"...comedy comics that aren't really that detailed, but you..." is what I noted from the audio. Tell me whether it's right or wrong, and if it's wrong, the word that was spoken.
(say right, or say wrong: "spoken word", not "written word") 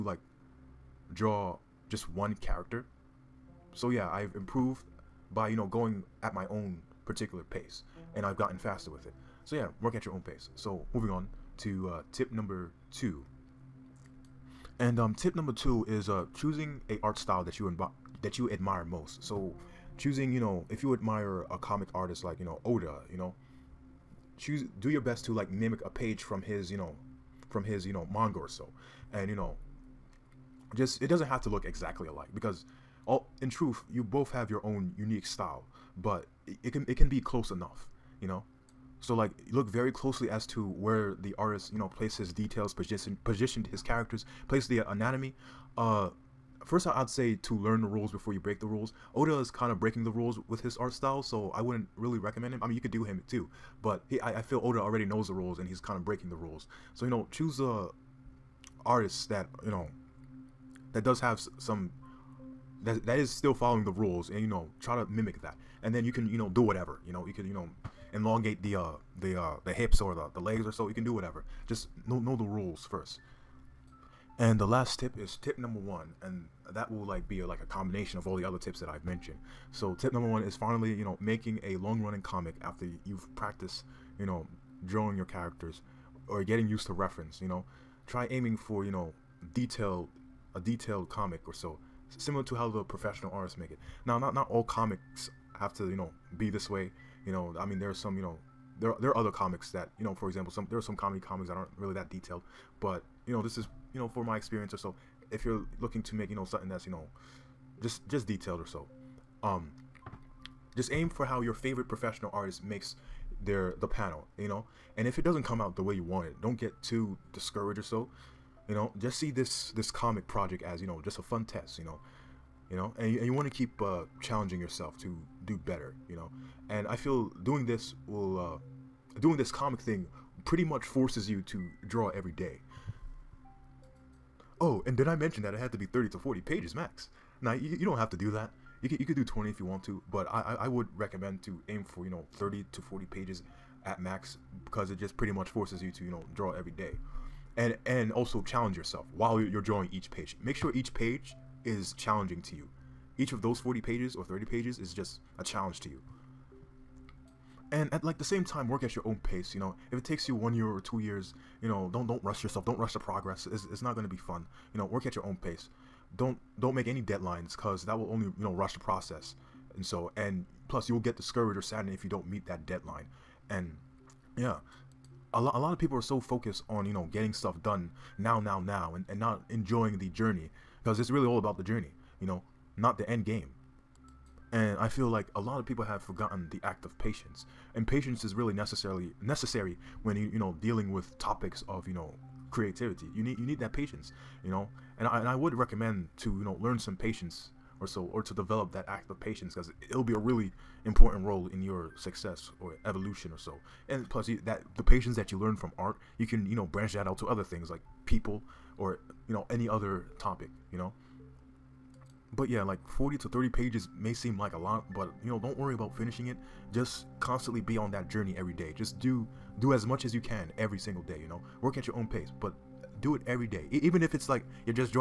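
right.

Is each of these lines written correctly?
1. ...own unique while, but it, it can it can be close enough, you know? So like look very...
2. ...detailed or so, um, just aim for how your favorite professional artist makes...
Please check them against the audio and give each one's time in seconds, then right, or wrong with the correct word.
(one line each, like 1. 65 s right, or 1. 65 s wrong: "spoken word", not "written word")
1. 34 s wrong: "style", not "while"
2. 108 s right.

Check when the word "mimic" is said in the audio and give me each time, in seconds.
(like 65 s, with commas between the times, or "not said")
25 s, 65 s.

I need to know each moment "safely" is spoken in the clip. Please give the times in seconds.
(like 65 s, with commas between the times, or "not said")
not said.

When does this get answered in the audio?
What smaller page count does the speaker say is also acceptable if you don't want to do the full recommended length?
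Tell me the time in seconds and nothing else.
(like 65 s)
139 s.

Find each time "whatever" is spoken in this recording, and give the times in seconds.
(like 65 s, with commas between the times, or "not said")
66 s, 71 s.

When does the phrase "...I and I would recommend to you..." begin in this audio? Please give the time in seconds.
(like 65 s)
195 s.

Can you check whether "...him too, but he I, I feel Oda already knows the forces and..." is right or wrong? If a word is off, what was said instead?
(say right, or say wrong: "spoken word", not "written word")
wrong: "rules", not "forces".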